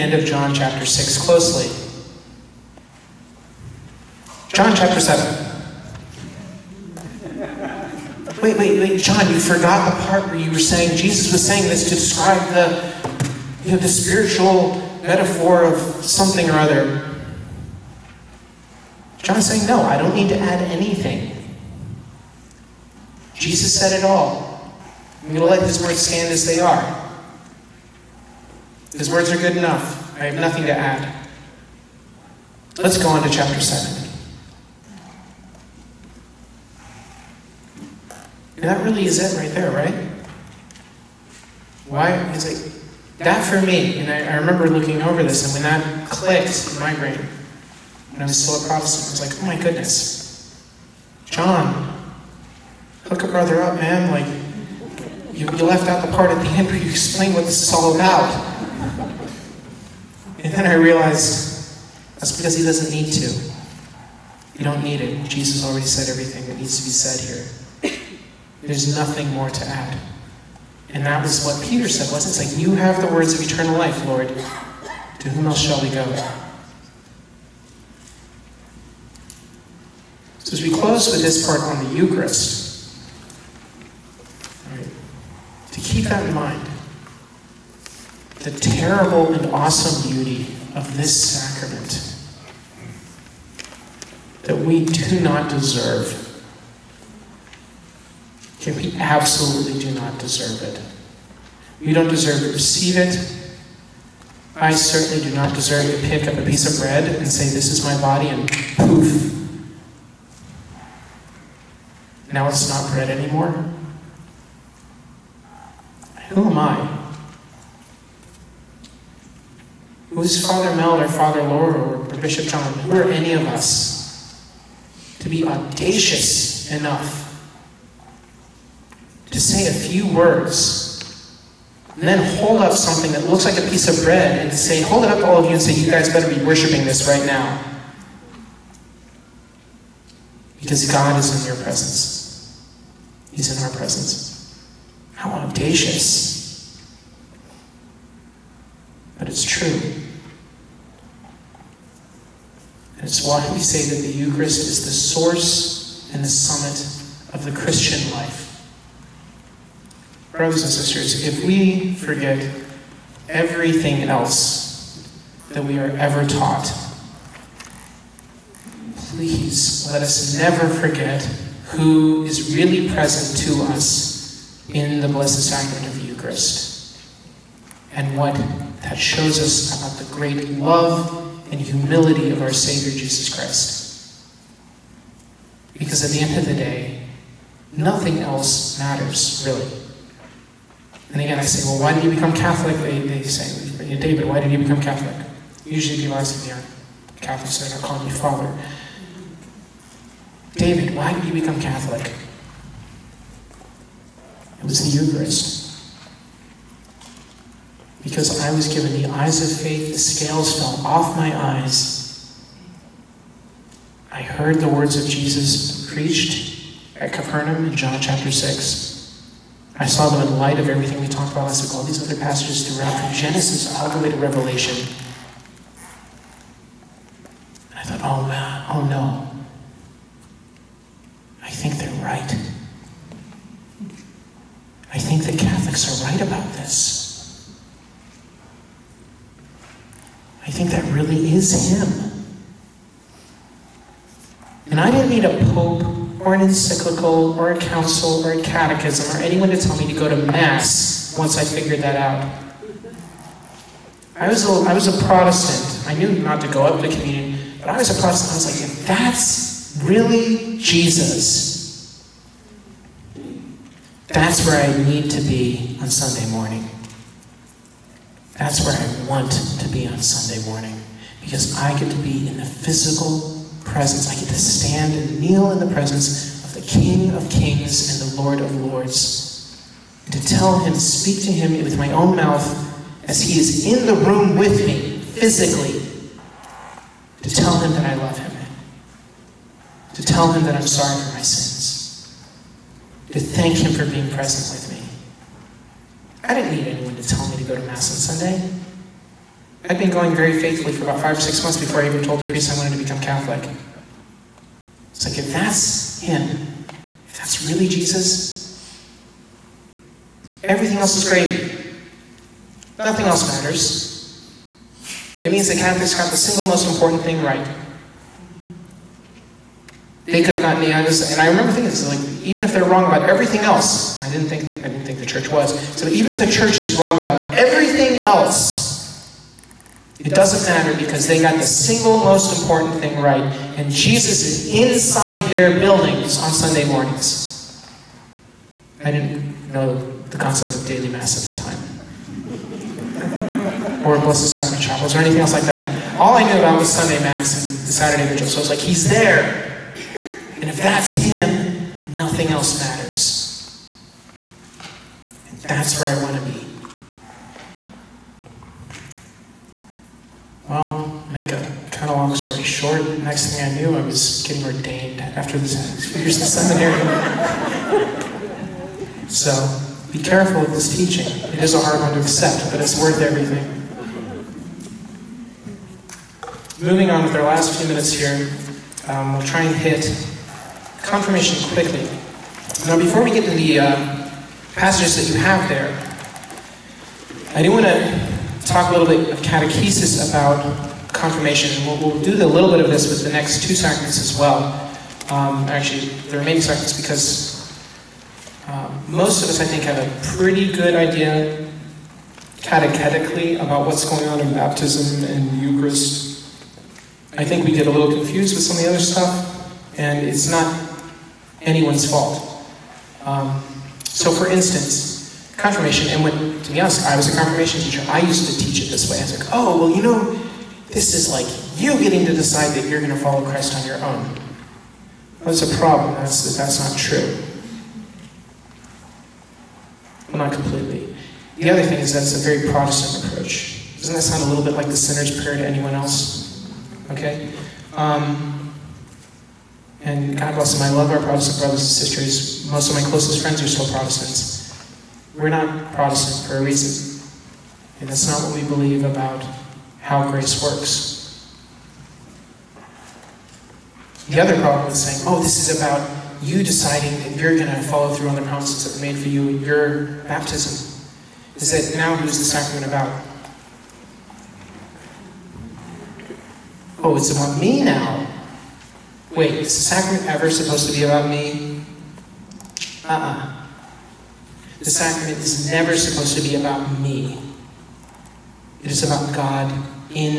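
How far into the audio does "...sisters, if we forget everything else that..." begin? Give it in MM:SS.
02:40.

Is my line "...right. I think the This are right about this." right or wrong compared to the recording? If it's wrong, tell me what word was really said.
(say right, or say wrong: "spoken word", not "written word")
wrong: "Catholics", not "This".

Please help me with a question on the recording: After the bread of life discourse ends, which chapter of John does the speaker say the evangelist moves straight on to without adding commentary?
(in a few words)
John chapter 7.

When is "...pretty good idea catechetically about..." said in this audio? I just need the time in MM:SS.
06:40.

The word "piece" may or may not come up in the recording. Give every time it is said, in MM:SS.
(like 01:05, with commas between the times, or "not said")
01:46, 02:13.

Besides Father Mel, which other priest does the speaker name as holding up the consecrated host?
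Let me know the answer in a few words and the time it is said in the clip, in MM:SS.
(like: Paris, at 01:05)
Father Laura, at 02:01.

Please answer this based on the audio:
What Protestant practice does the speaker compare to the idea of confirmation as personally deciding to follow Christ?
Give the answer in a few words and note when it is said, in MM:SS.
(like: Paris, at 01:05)
The sinner's prayer, at 07:14.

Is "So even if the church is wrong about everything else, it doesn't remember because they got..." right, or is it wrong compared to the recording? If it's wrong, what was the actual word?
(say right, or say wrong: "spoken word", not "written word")
wrong: "matter", not "remember".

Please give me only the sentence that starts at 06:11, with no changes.
It is a hard one to accept, but it's worth everything.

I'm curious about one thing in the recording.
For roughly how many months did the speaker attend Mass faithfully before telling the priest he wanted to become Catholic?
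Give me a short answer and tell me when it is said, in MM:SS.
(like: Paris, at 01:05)
5 or 6 months, at 05:00.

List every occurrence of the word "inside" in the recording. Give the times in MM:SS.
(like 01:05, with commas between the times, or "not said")
05:34.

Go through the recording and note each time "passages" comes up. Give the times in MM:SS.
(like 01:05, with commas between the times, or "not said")
03:42, 06:24.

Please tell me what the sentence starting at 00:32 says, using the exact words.
Let's go on to chapter 7.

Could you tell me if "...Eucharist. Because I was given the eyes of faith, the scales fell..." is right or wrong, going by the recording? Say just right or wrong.
right.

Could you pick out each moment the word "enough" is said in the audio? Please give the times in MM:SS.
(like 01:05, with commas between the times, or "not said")
00:29, 02:06.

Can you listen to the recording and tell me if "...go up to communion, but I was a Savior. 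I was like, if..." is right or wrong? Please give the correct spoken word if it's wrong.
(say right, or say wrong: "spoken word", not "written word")
wrong: "Protestant", not "Savior".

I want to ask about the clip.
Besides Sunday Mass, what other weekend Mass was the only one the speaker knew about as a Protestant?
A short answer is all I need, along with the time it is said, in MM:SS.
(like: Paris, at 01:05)
Saturday vigil, at 05:47.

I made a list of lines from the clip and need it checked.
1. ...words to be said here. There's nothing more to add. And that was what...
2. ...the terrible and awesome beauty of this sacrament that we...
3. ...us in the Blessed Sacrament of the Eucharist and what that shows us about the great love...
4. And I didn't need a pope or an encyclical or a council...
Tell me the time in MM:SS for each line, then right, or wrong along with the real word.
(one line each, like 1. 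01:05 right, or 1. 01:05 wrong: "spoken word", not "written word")
1. 01:06 wrong: "needs", not "words"
2. 01:28 right
3. 02:53 right
4. 04:04 right.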